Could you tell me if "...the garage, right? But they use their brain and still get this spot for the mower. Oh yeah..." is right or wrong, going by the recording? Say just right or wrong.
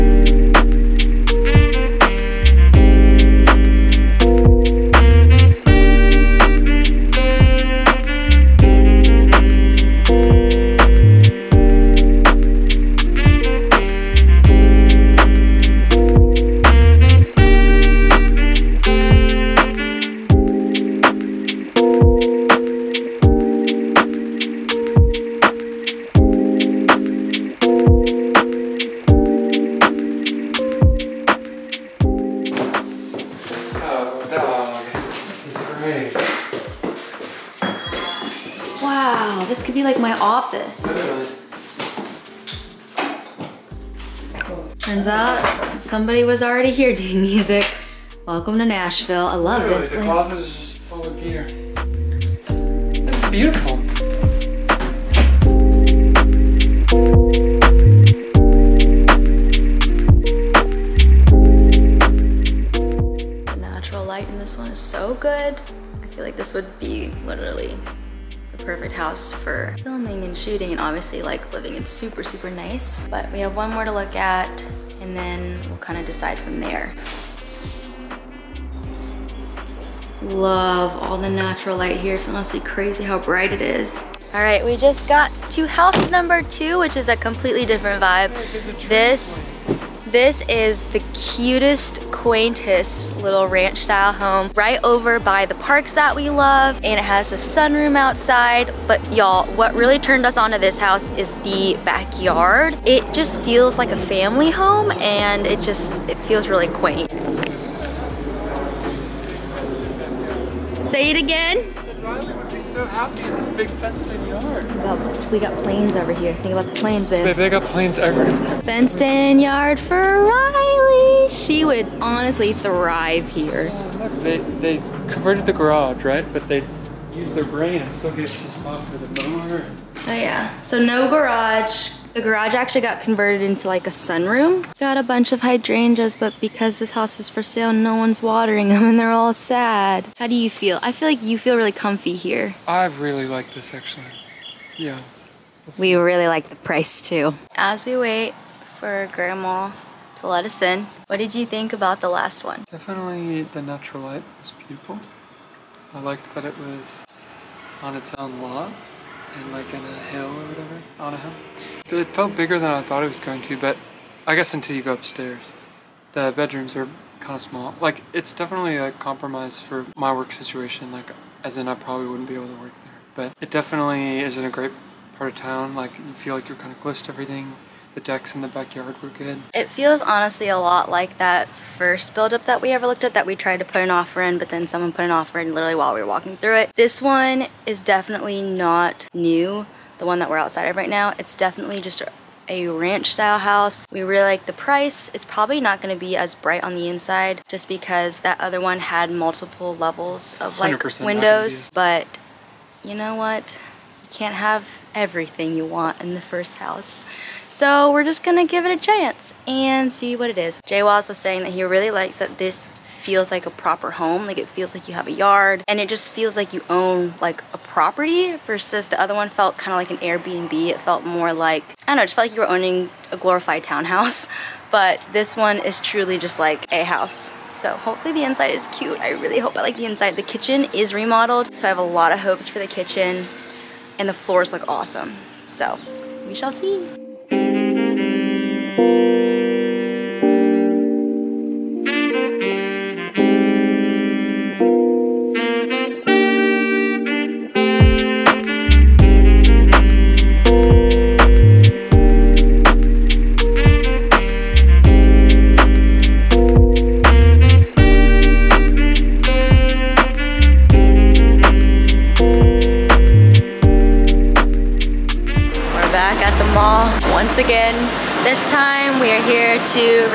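right.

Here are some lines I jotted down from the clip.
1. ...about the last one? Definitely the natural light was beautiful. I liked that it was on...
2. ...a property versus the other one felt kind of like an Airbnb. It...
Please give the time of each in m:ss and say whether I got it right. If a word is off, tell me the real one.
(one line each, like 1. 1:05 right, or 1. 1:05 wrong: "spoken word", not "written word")
1. 2:31 right
2. 3:37 right.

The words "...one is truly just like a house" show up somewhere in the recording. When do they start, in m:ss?
3:45.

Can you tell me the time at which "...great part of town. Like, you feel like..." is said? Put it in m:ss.
2:54.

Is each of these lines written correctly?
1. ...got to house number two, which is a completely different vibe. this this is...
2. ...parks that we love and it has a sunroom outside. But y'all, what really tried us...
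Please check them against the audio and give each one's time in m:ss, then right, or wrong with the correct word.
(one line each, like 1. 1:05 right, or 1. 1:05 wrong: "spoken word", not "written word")
1. 1:25 right
2. 1:35 wrong: "turned", not "tried".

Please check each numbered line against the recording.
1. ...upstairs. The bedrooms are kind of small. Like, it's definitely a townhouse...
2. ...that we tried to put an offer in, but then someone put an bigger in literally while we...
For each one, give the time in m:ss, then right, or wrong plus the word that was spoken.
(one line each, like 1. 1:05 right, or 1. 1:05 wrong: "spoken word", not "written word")
1. 2:44 wrong: "compromise", not "townhouse"
2. 3:03 wrong: "offer", not "bigger".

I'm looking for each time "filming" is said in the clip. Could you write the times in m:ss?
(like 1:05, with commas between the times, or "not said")
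1:09.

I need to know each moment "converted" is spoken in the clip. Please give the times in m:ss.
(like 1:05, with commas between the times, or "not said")
2:05, 2:13.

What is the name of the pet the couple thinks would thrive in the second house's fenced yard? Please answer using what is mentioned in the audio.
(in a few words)
Riley.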